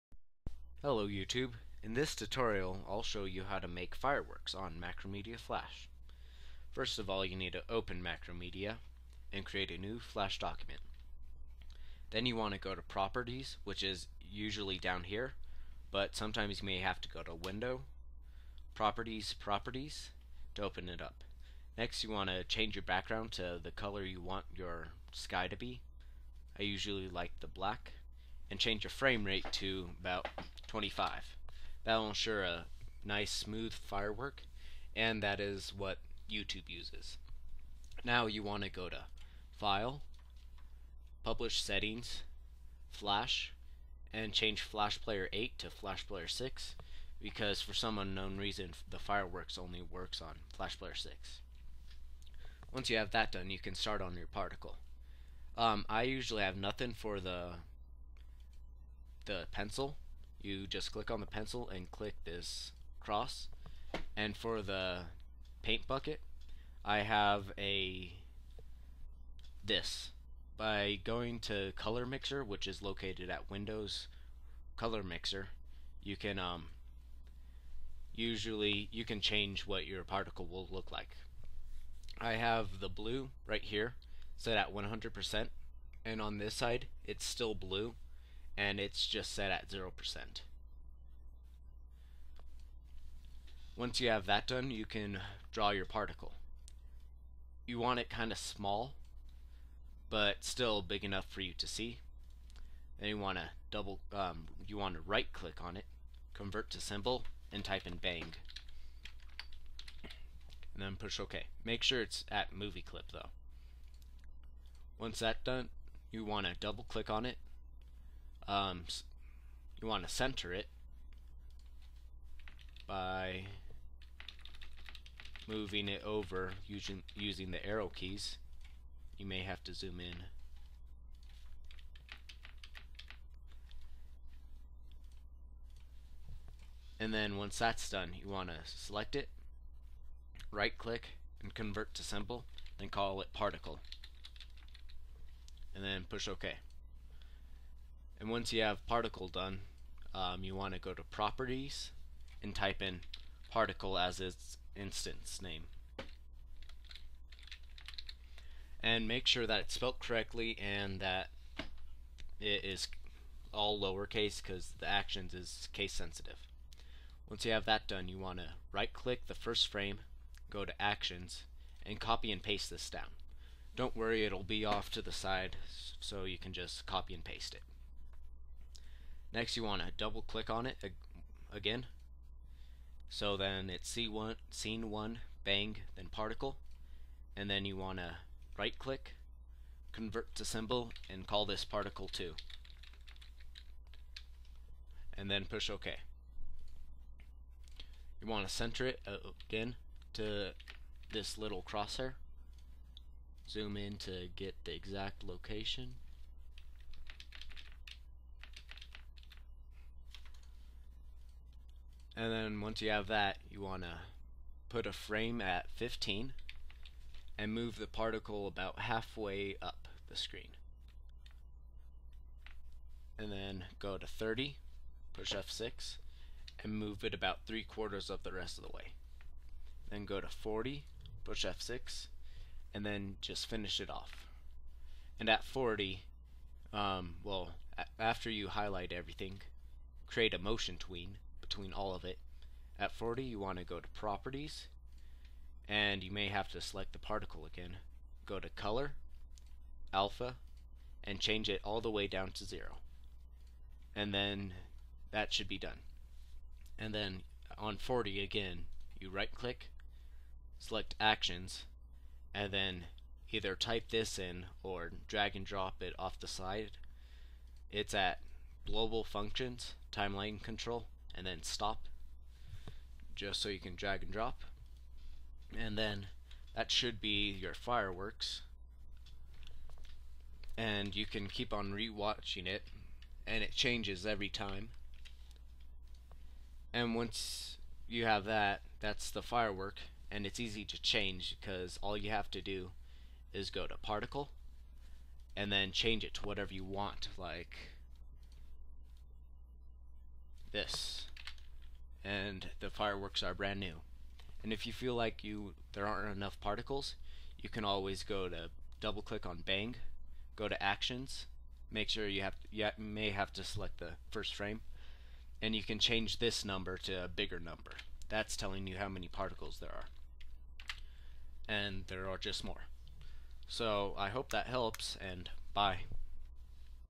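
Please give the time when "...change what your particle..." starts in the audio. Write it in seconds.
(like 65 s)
79 s.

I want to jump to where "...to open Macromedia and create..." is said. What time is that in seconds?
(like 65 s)
7 s.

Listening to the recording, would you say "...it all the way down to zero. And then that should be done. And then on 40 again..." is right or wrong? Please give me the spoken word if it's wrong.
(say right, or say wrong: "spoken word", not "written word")
right.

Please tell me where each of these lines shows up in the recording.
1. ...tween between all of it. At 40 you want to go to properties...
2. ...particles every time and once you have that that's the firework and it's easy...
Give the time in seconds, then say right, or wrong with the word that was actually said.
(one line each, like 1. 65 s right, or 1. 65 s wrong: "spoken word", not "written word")
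1. 240 s right
2. 283 s wrong: "changes", not "particles".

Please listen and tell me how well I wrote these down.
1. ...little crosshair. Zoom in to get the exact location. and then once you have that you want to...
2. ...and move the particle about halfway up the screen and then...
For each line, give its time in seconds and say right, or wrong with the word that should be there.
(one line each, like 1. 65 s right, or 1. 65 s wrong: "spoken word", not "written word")
1. 201 s right
2. 217 s right.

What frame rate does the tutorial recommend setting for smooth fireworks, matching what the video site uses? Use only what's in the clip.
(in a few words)
25.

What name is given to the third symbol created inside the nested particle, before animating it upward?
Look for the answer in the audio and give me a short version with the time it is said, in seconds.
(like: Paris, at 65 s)
particle 2, at 191 s.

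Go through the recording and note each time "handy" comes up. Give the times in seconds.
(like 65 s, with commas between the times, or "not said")
not said.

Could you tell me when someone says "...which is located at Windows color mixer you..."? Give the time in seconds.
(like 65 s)
72 s.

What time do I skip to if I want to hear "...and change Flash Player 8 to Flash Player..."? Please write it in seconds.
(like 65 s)
44 s.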